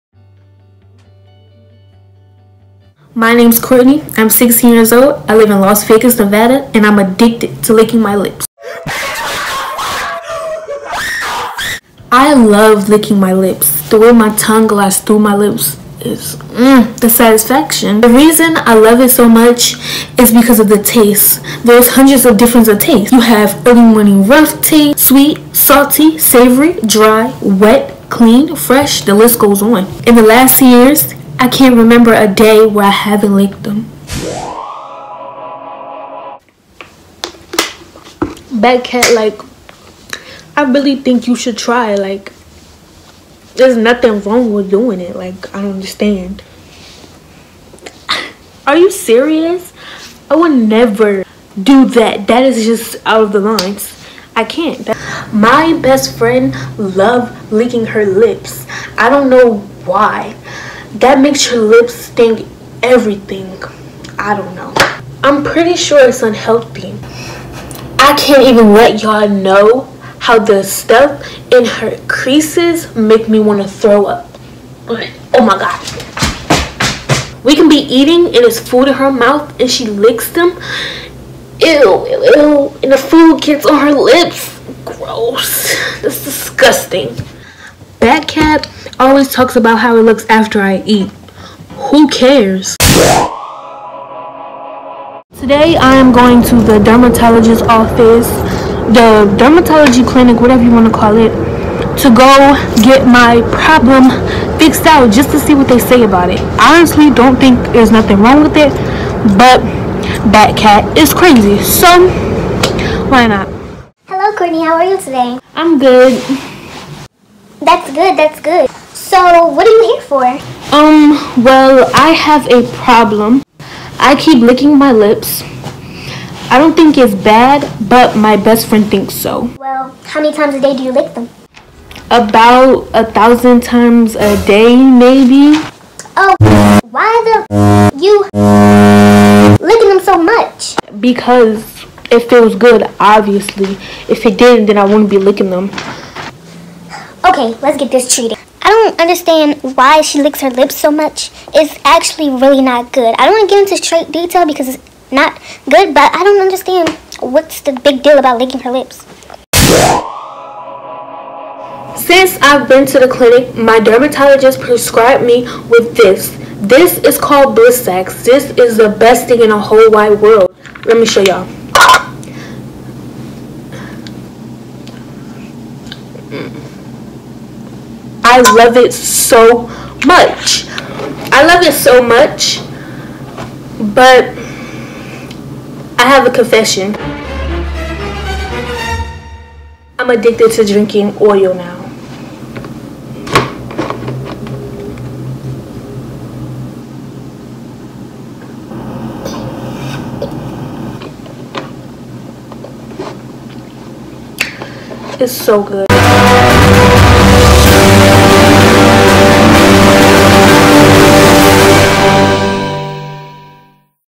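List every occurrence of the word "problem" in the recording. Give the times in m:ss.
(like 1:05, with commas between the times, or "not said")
1:43, 2:02.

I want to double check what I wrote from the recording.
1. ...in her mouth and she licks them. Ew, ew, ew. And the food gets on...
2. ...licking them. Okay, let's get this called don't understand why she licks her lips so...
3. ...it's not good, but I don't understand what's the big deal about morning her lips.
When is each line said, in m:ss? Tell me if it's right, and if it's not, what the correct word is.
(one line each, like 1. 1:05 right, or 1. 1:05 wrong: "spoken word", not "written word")
1. 1:18 right
2. 2:25 wrong: "treated", not "called"
3. 2:34 wrong: "licking", not "morning".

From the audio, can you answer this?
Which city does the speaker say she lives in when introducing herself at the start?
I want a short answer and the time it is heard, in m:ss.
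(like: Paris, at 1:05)
Las Vegas, at 0:05.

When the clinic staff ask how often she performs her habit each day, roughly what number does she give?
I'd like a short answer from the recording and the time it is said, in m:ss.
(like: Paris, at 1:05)
1000, at 2:12.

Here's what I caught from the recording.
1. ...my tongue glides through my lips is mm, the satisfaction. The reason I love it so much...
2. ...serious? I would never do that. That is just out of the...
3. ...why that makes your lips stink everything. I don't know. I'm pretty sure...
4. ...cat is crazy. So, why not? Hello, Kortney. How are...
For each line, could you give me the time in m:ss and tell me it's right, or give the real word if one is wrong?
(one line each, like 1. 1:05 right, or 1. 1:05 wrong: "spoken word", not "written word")
1. 0:14 right
2. 0:48 right
3. 0:59 right
4. 1:50 right.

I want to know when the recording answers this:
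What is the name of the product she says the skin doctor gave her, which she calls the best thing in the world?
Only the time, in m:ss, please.
2:47.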